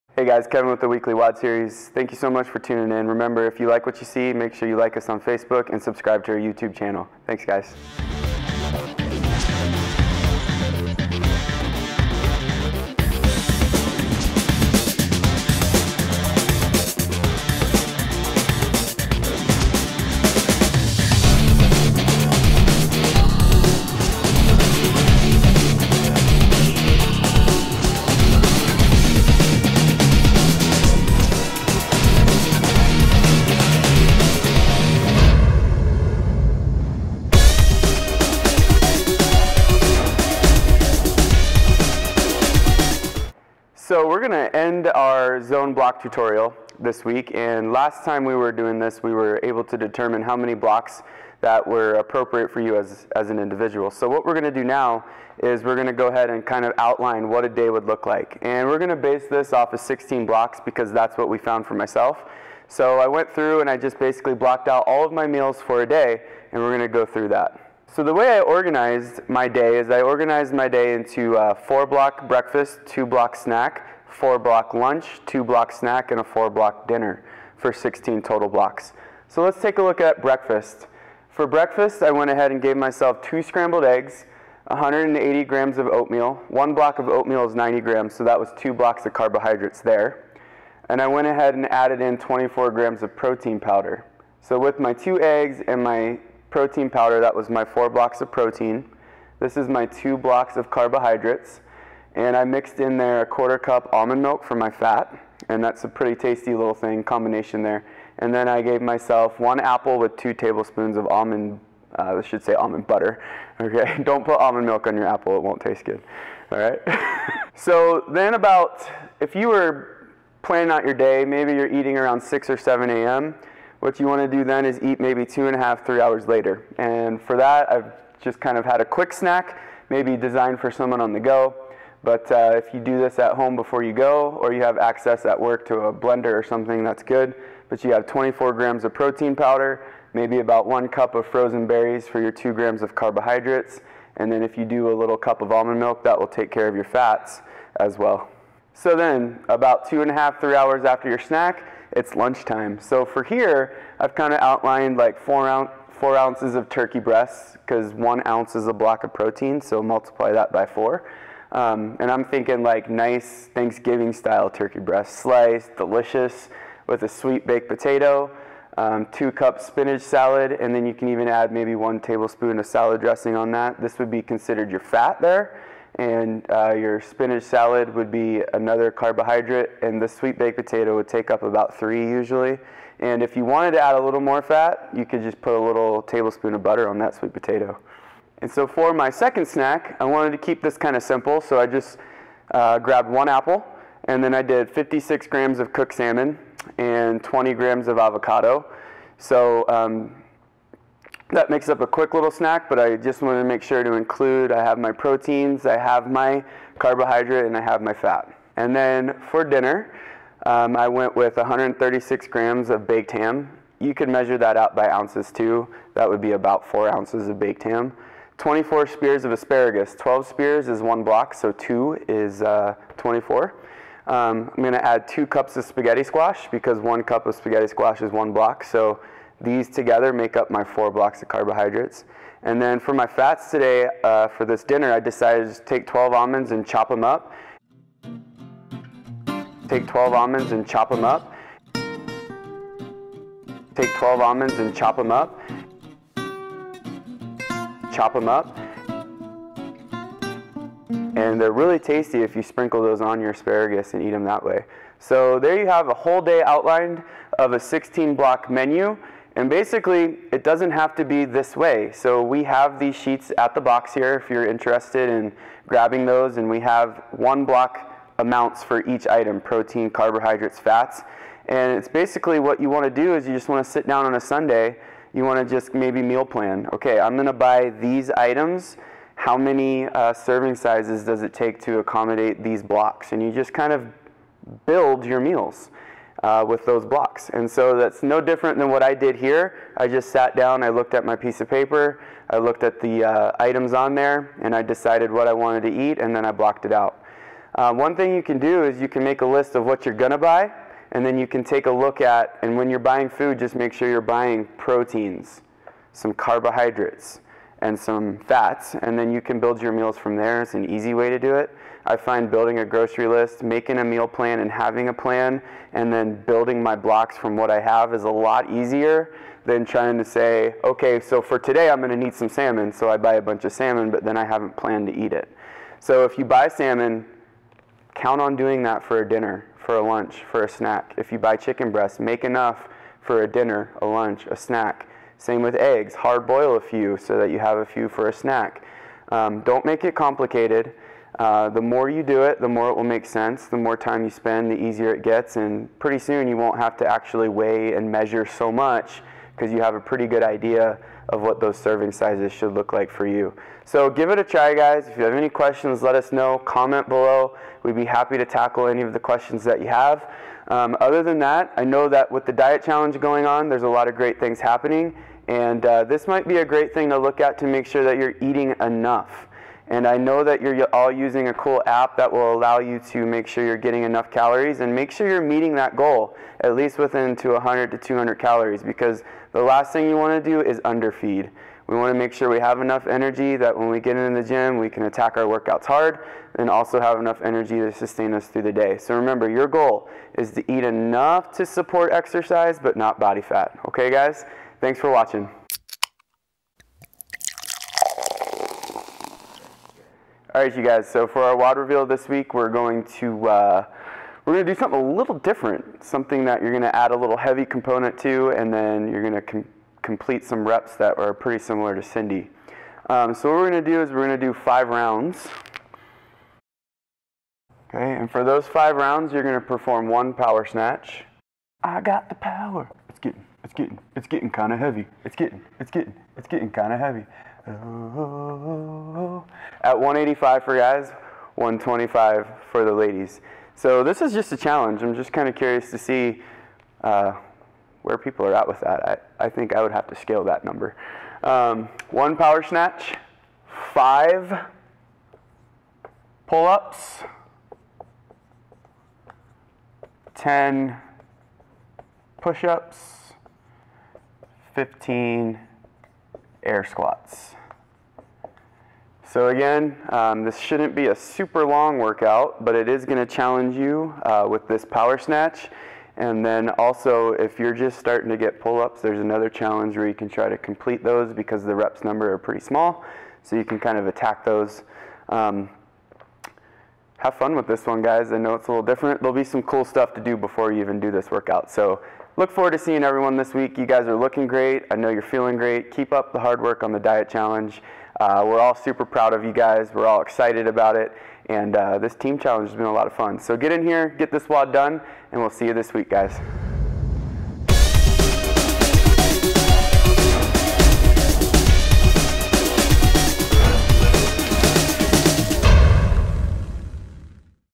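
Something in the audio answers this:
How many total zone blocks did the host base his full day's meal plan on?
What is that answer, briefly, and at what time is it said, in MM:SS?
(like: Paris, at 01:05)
16, at 00:59.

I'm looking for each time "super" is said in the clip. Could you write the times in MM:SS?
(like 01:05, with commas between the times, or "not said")
07:40, 08:08.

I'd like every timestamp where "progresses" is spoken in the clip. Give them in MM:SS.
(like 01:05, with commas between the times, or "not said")
not said.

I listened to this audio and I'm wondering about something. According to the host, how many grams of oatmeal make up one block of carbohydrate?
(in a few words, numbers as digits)
90 grams.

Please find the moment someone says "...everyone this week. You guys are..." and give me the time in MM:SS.
08:02.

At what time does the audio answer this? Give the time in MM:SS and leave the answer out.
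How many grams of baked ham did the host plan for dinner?
03:31.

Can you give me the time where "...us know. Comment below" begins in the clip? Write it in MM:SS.
05:55.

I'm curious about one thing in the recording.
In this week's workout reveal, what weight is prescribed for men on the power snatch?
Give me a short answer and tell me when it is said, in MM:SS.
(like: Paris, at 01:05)
185, at 07:09.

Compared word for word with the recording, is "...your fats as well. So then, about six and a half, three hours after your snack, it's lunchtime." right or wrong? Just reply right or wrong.
wrong.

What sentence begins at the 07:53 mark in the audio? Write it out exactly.
So you can kind of attack those.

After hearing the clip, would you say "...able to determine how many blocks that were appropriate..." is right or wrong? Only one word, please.
right.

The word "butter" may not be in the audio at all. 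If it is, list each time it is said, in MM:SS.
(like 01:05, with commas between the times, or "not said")
01:52, 03:06.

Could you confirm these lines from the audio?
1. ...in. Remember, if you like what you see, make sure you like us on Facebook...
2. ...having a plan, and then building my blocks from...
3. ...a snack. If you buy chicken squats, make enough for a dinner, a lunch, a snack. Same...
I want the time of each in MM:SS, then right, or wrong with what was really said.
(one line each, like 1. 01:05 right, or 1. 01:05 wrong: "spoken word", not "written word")
1. 00:02 right
2. 05:14 right
3. 05:30 wrong: "breasts", not "squats".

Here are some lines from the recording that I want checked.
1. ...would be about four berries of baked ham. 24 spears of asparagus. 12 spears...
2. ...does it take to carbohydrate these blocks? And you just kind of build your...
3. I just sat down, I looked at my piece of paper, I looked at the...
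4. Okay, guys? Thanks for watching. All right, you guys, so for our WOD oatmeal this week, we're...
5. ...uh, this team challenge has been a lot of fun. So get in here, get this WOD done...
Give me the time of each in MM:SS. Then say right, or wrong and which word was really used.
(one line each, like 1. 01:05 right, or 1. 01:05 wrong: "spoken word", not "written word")
1. 03:36 wrong: "ounces", not "berries"
2. 04:41 wrong: "accommodate", not "carbohydrate"
3. 04:49 right
4. 06:33 wrong: "reveal", not "oatmeal"
5. 08:11 right.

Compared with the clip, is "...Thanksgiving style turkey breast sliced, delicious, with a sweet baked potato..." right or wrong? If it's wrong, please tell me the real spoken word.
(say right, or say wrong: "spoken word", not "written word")
right.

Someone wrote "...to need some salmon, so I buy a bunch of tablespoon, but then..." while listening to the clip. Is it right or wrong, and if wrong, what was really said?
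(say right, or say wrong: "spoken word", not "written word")
wrong: "salmon", not "tablespoon".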